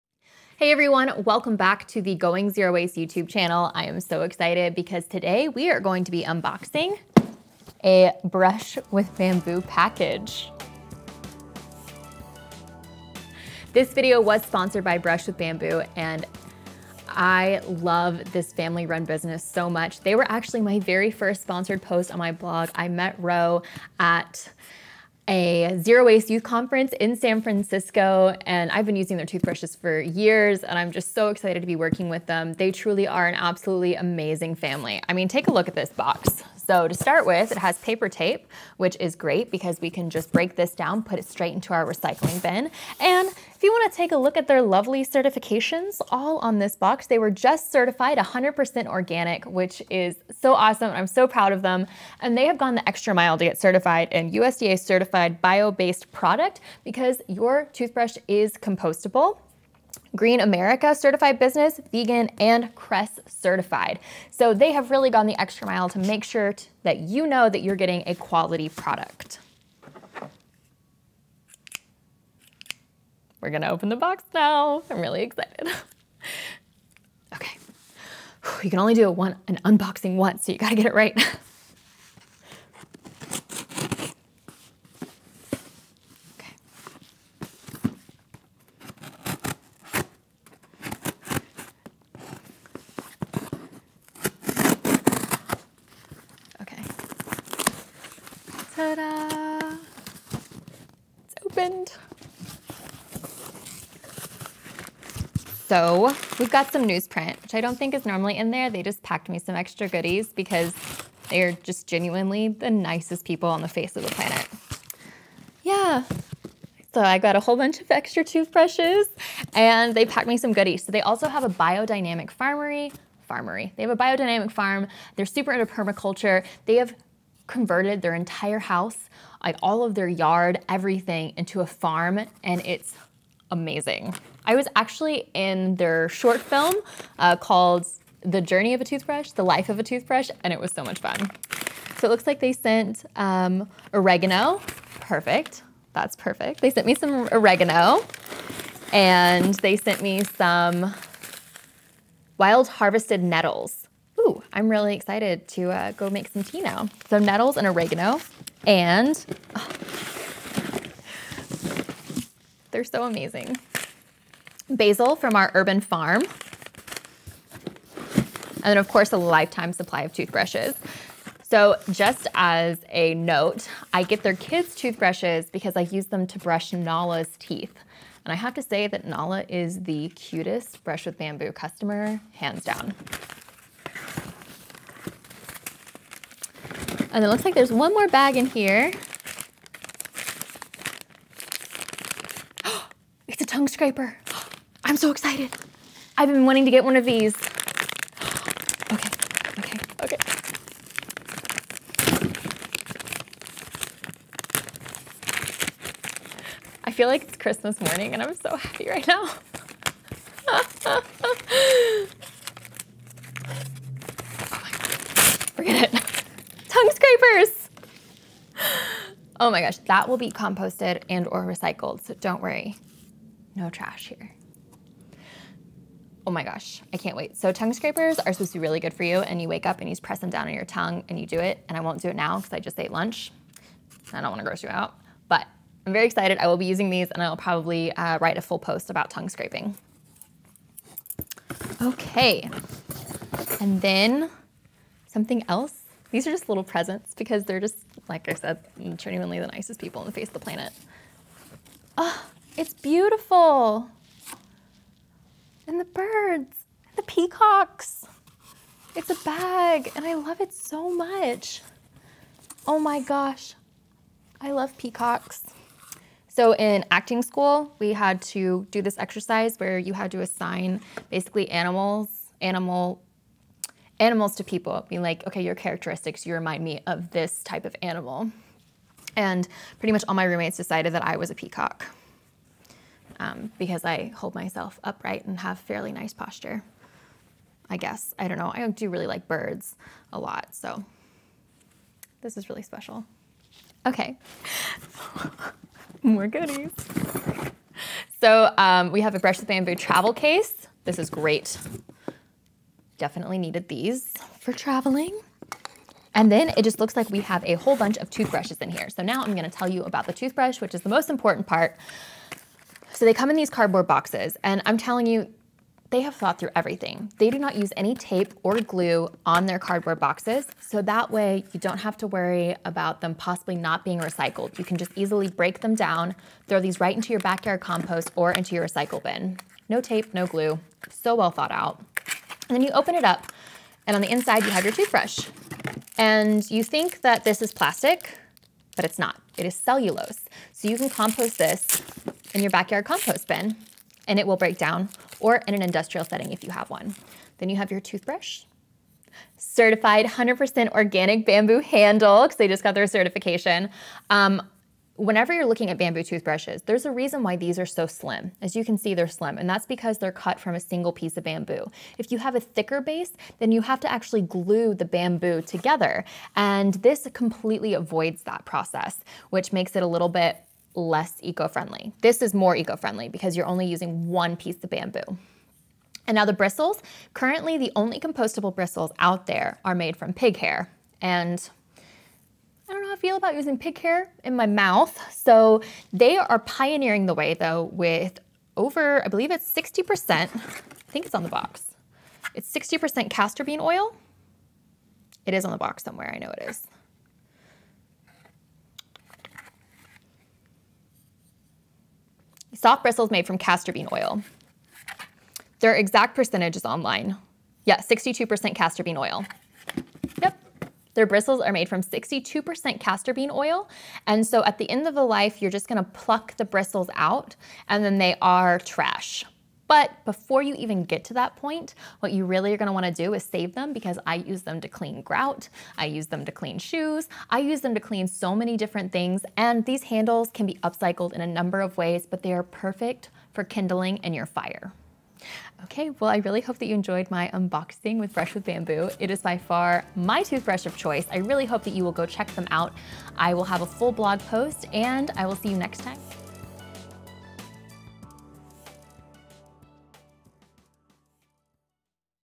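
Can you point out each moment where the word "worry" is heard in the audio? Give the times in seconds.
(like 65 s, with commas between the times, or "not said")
222 s, 322 s.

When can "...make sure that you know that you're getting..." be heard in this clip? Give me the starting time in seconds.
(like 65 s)
65 s.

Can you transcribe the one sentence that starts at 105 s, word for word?
So we've got some newsprint, which I don't think is normally in there.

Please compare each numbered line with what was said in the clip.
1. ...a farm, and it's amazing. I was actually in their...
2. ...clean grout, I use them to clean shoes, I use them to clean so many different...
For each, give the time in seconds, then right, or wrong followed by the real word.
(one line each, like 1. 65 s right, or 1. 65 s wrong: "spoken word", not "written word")
1. 131 s right
2. 424 s right.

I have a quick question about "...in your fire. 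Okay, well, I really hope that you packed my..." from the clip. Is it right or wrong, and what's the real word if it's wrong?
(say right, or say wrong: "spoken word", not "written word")
wrong: "enjoyed", not "packed".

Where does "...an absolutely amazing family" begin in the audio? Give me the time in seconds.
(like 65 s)
33 s.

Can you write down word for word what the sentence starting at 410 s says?
Their bristles are made from 62% castor bean oil.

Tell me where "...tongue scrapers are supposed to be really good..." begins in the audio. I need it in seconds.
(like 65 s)
227 s.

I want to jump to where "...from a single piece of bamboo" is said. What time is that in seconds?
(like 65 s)
360 s.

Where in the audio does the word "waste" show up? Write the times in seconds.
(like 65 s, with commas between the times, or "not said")
2 s, 26 s.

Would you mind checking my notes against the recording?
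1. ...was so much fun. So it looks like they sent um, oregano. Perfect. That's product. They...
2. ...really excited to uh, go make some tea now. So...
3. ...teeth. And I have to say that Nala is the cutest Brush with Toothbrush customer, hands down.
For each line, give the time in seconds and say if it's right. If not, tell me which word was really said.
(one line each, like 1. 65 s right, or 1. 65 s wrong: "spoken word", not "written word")
1. 140 s wrong: "perfect", not "product"
2. 154 s right
3. 177 s wrong: "Bamboo", not "Toothbrush".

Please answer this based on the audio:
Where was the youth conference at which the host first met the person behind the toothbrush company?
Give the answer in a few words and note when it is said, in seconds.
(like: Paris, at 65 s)
San Francisco, at 27 s.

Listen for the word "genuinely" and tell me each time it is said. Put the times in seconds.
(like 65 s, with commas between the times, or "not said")
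111 s, 248 s.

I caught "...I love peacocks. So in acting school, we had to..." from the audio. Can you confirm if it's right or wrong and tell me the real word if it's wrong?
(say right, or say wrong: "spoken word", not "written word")
right.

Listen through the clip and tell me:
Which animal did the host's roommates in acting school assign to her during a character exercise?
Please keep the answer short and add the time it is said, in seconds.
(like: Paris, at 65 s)
peacock, at 281 s.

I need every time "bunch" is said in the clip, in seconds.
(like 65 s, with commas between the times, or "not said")
117 s, 307 s.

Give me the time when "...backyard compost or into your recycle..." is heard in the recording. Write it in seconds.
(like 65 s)
327 s.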